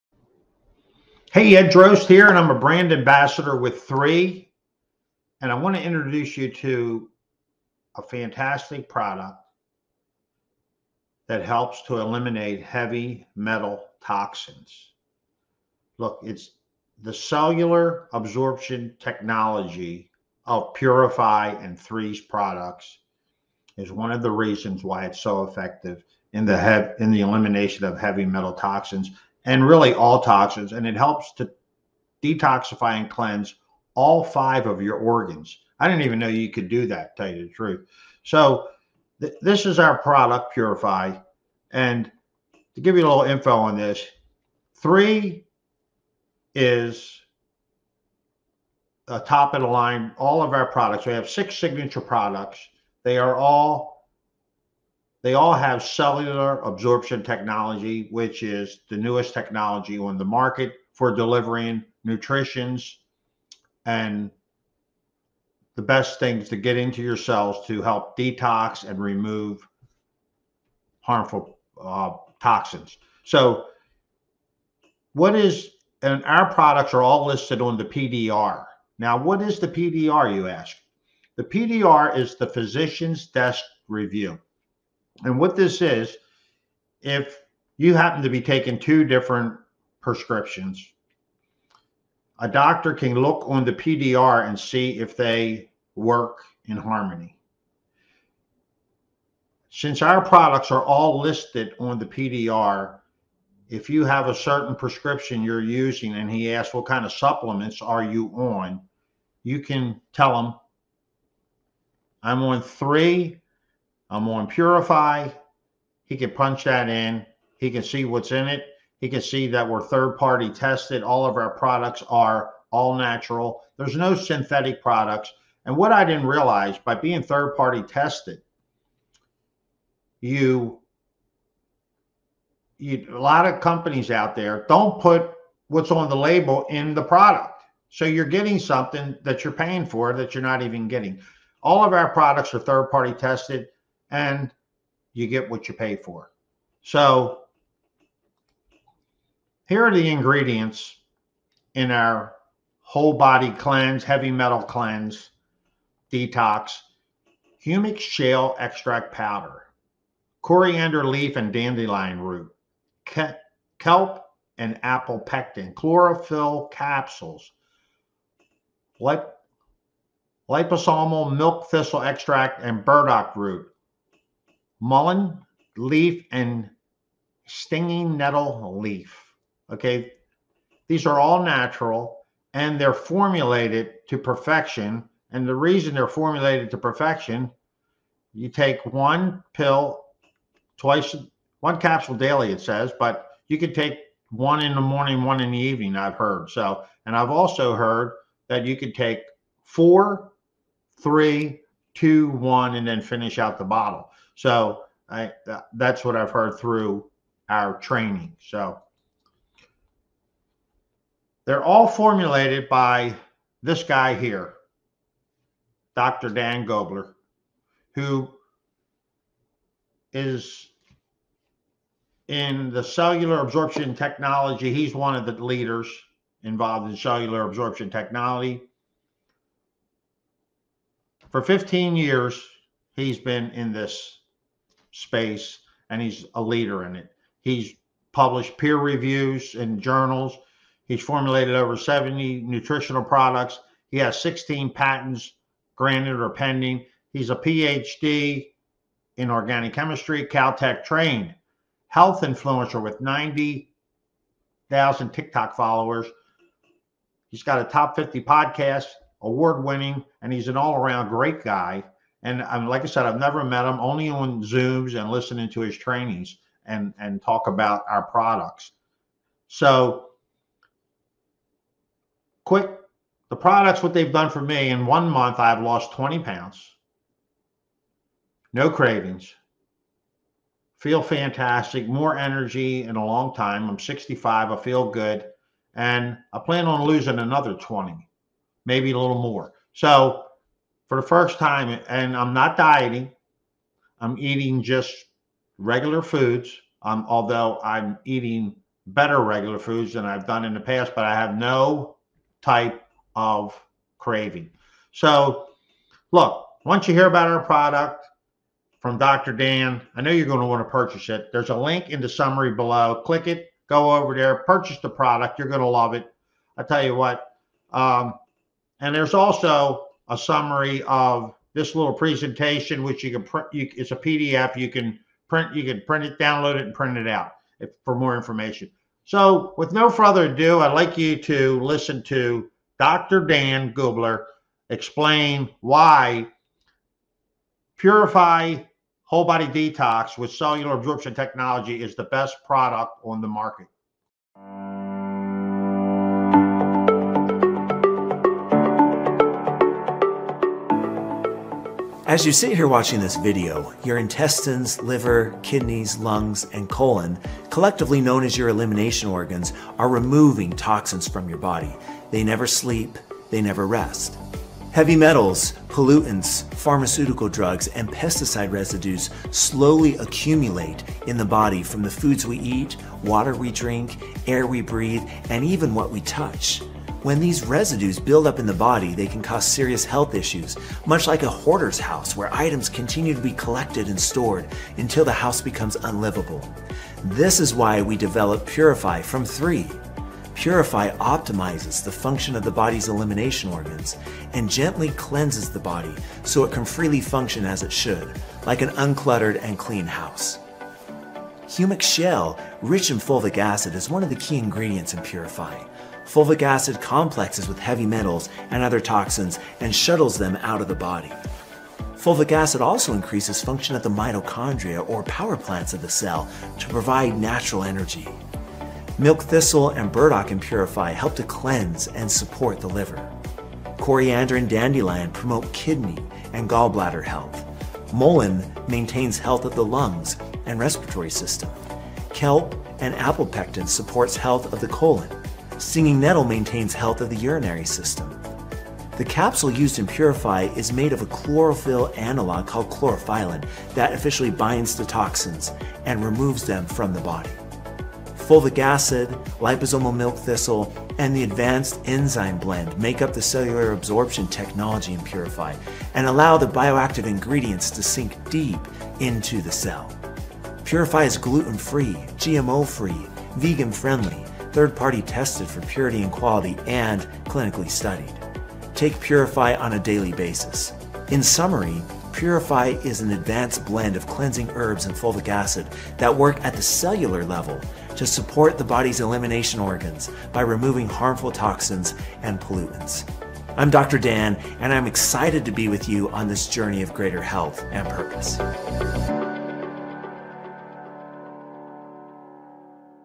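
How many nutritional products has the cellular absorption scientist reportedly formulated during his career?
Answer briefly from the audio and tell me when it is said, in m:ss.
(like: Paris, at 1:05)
Over 70, at 4:01.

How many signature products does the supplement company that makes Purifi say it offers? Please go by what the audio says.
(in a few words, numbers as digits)
6.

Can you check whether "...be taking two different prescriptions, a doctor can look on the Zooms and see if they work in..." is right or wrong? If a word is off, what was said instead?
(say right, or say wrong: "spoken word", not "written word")
wrong: "PDR", not "Zooms".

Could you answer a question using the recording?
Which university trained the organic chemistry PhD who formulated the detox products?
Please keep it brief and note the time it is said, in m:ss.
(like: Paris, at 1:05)
Caltech, at 4:10.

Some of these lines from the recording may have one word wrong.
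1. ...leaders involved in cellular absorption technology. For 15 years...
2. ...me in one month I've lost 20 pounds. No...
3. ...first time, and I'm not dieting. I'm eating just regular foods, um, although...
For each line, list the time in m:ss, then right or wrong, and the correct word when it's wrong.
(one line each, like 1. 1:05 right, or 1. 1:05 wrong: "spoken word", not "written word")
1. 3:45 right
2. 4:34 right
3. 4:51 right.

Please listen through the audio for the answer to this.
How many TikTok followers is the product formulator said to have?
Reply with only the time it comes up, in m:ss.
4:13.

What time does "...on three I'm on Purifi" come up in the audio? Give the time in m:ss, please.
1:52.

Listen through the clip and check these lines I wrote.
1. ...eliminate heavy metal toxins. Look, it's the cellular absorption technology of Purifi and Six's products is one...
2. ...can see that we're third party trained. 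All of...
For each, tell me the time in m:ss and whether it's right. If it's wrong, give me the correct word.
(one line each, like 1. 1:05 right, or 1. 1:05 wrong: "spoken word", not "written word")
1. 0:11 wrong: "Three", not "Six"
2. 1:59 wrong: "tested", not "trained".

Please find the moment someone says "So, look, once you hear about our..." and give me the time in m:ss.
5:04.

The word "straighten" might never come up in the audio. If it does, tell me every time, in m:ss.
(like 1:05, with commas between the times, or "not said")
not said.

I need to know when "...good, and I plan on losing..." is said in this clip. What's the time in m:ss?
4:44.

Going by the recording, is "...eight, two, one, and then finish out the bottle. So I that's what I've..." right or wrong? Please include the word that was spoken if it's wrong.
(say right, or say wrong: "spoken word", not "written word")
wrong: "three", not "eight".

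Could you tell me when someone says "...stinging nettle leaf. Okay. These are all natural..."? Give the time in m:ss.
2:57.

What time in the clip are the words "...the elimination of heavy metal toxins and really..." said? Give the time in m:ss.
0:27.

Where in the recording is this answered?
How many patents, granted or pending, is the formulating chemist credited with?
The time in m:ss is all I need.
4:04.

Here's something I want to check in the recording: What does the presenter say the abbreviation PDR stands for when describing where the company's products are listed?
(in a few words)
Physician's Desk Review.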